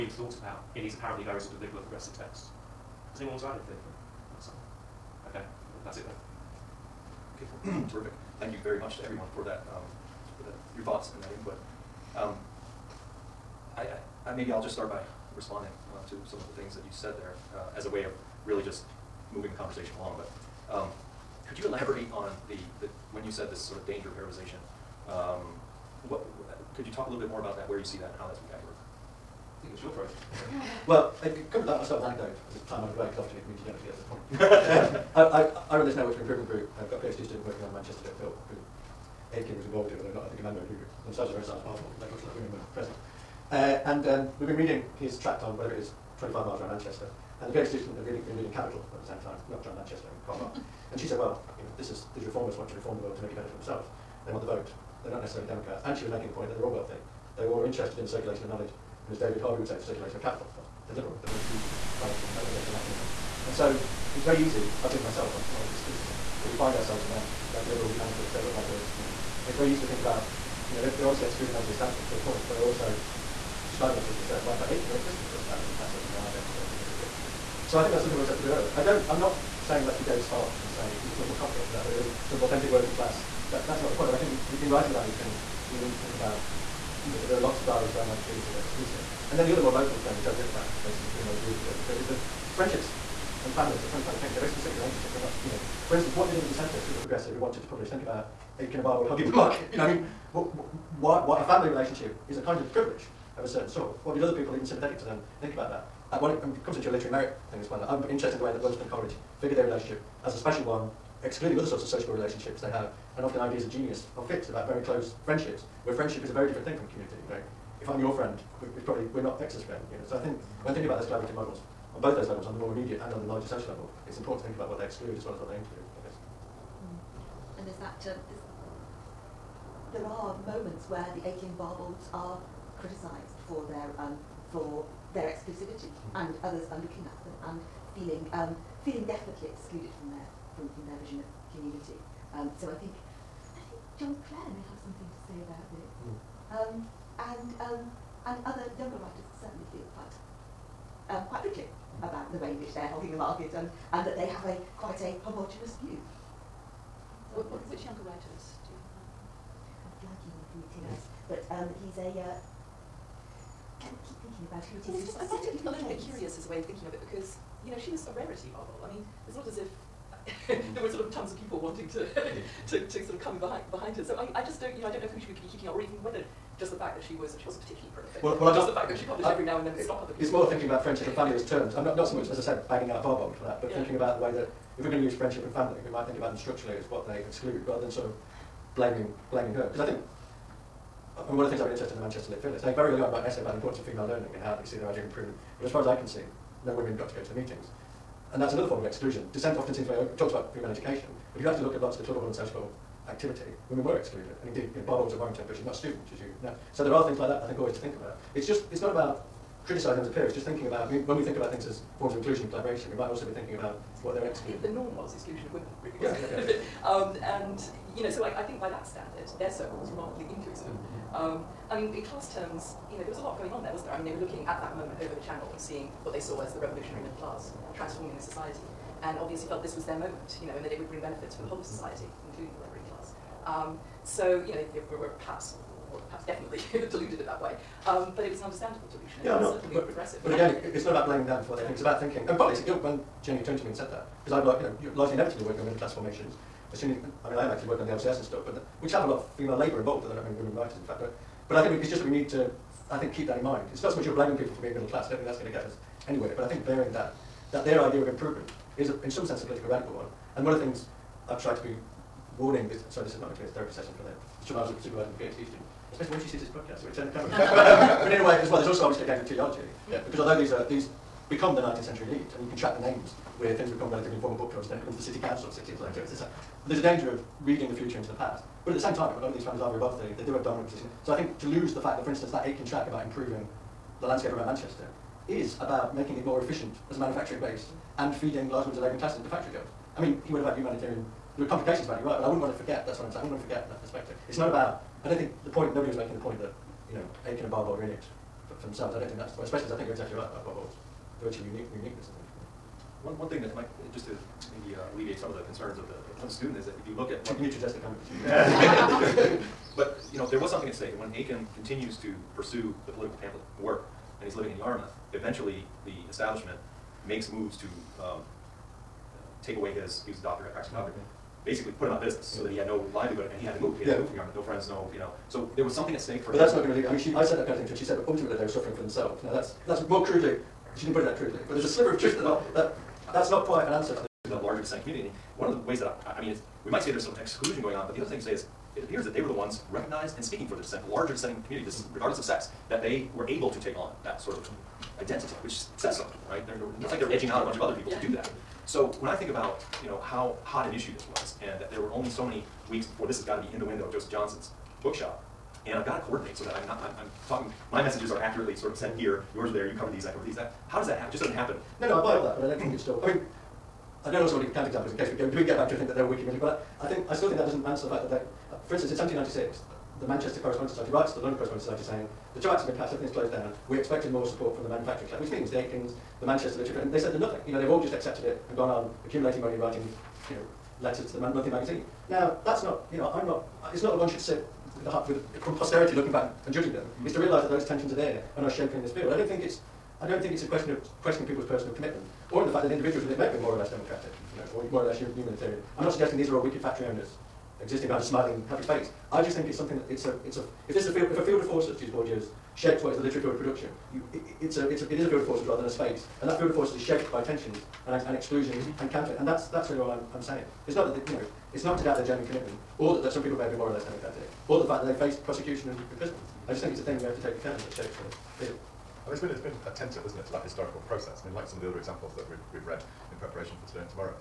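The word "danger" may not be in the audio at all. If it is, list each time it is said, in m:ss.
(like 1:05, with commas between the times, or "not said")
0:23, 4:36.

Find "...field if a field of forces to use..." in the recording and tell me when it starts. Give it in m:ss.
6:40.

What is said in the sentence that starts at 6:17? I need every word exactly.
You know, they've all just accepted it and gone on accumulating money and writing, you know, letters to the monthly magazine.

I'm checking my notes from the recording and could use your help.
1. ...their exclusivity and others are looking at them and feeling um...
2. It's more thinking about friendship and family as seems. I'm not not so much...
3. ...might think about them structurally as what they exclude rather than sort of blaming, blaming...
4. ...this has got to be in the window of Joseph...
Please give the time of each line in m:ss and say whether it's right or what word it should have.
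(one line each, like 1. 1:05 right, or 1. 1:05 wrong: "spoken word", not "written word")
1. 2:15 right
2. 3:00 wrong: "terms", not "seems"
3. 3:05 right
4. 5:53 right.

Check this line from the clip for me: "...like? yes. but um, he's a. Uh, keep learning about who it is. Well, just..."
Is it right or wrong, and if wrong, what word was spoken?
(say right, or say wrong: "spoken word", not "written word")
wrong: "thinking", not "learning".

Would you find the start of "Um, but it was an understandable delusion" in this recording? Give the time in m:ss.
3:57.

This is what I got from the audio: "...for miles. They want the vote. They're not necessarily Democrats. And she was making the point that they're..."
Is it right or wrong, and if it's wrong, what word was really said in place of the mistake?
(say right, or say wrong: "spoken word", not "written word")
wrong: "themselves", not "miles".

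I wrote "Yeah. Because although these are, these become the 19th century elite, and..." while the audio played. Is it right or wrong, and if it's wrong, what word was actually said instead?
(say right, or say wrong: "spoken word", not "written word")
right.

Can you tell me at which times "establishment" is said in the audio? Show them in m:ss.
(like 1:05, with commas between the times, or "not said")
1:11, 5:16.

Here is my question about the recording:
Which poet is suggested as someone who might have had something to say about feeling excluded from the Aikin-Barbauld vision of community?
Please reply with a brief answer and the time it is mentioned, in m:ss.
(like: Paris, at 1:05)
John Clare, at 2:23.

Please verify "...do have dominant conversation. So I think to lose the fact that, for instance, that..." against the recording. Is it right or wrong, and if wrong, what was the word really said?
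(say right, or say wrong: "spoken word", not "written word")
wrong: "position", not "conversation".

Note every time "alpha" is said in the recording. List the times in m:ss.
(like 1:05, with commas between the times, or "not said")
not said.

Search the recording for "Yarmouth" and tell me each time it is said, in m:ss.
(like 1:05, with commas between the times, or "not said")
5:14, 5:24.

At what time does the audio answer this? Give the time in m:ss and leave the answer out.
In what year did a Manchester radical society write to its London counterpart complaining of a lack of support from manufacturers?
6:08.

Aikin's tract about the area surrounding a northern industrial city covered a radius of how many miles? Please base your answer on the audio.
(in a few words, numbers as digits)
25.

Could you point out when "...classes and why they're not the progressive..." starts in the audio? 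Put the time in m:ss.
1:15.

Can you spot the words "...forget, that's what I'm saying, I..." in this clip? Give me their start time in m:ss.
4:52.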